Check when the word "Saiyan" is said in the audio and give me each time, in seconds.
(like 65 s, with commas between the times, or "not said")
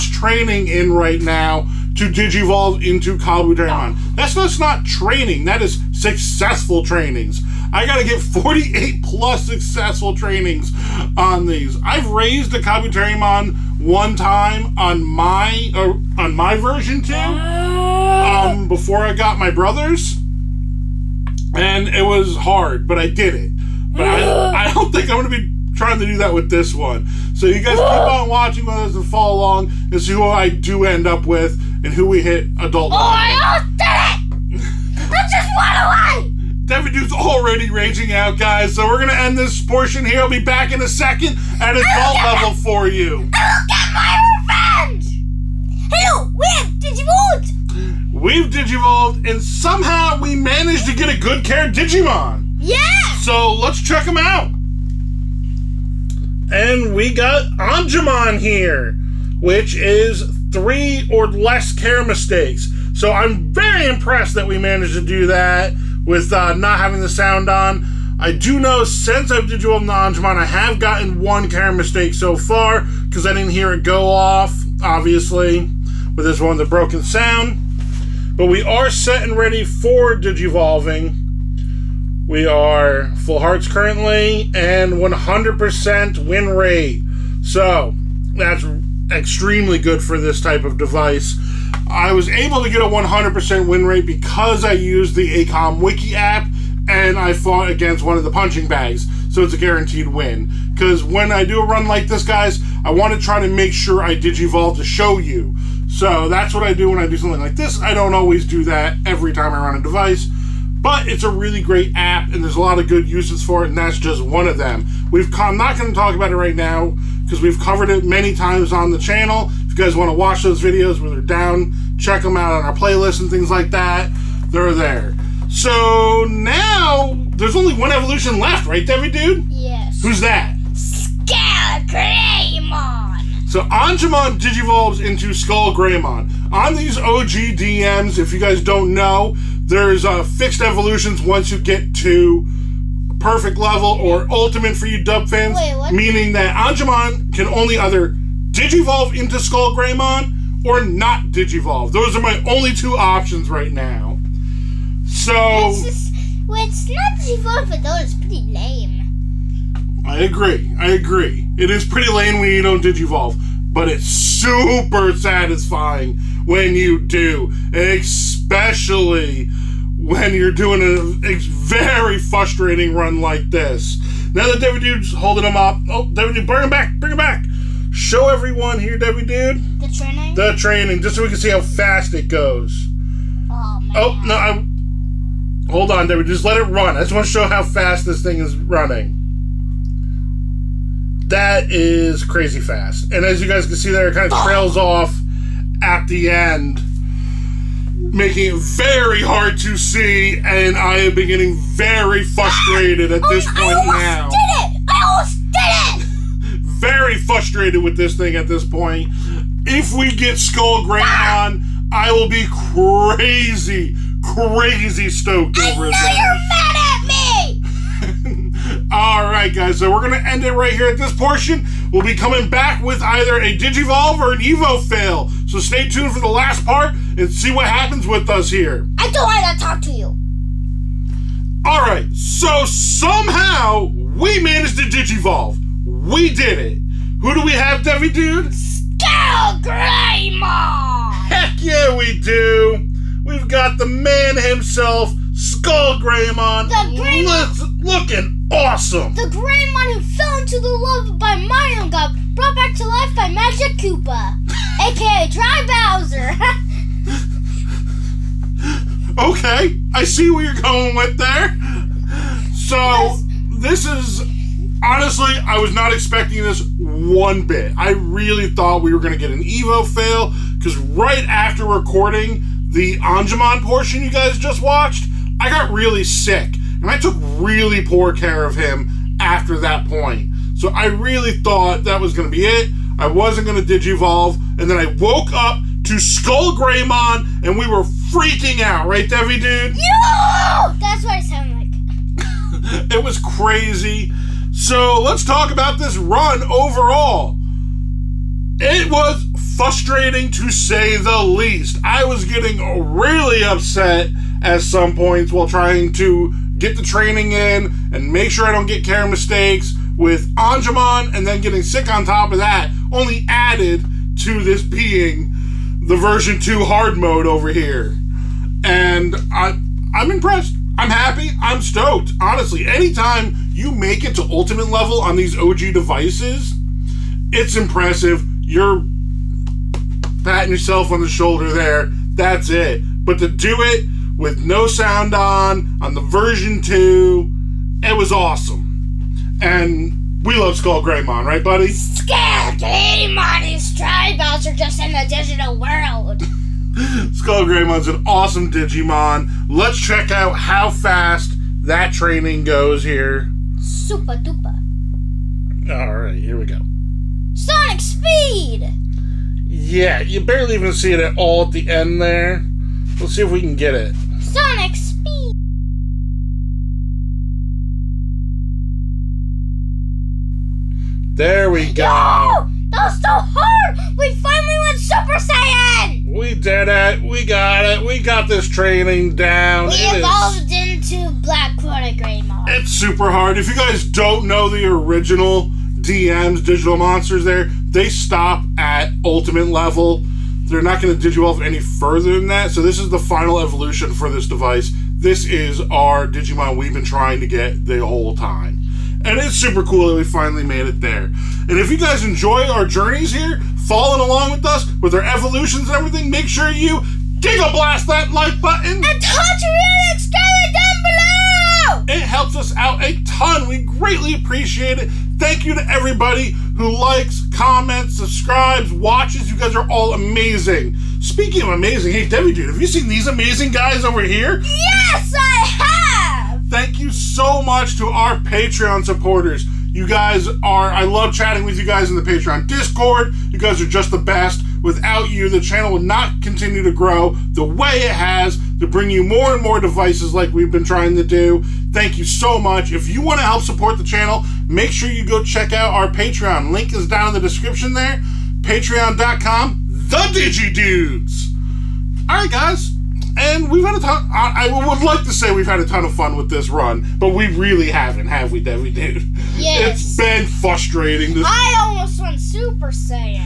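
376 s, 462 s.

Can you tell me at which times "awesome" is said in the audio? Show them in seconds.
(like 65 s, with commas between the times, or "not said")
248 s, 338 s, 348 s.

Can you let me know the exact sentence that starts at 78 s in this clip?
But we are set and ready for Digivolving.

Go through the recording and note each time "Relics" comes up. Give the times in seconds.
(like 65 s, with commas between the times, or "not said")
409 s.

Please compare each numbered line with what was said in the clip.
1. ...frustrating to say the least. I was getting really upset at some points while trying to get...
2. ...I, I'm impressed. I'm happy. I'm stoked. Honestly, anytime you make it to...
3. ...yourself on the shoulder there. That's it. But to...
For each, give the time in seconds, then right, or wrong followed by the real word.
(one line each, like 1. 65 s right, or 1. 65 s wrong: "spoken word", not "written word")
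1. 299 s right
2. 319 s right
3. 330 s right.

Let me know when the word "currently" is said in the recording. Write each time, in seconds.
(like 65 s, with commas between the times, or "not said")
83 s.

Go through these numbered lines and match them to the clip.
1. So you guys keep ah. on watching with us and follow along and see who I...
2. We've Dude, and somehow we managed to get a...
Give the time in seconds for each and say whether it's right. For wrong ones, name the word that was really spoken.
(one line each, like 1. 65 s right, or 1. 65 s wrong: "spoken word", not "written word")
1. 27 s right
2. 48 s wrong: "Digivolved", not "Dude".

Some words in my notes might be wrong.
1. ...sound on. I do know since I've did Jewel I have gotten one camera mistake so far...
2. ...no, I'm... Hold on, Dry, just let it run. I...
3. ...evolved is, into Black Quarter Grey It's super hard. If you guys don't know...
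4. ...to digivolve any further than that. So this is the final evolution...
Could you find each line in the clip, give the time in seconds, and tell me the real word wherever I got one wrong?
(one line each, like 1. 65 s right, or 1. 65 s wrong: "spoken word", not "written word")
1. 67 s right
2. 184 s wrong: "David", not "Dry"
3. 379 s right
4. 390 s right.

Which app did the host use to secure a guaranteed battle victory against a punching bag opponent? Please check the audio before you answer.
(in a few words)
ACOM Wiki.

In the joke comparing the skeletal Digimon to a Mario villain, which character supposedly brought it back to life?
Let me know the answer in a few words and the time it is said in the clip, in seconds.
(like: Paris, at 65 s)
Magic Koopa, at 253 s.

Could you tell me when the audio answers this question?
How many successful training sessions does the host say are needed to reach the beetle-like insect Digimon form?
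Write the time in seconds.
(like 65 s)
8 s.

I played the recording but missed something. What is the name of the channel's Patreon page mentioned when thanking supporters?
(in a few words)
The Digi Dudes.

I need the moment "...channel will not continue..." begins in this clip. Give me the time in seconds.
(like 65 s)
435 s.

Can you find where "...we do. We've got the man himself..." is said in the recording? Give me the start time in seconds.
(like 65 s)
241 s.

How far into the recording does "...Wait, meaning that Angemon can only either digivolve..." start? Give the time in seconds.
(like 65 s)
145 s.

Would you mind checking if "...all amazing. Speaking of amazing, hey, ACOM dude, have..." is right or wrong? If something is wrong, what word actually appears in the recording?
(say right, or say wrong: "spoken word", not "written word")
wrong: "Debbie", not "ACOM".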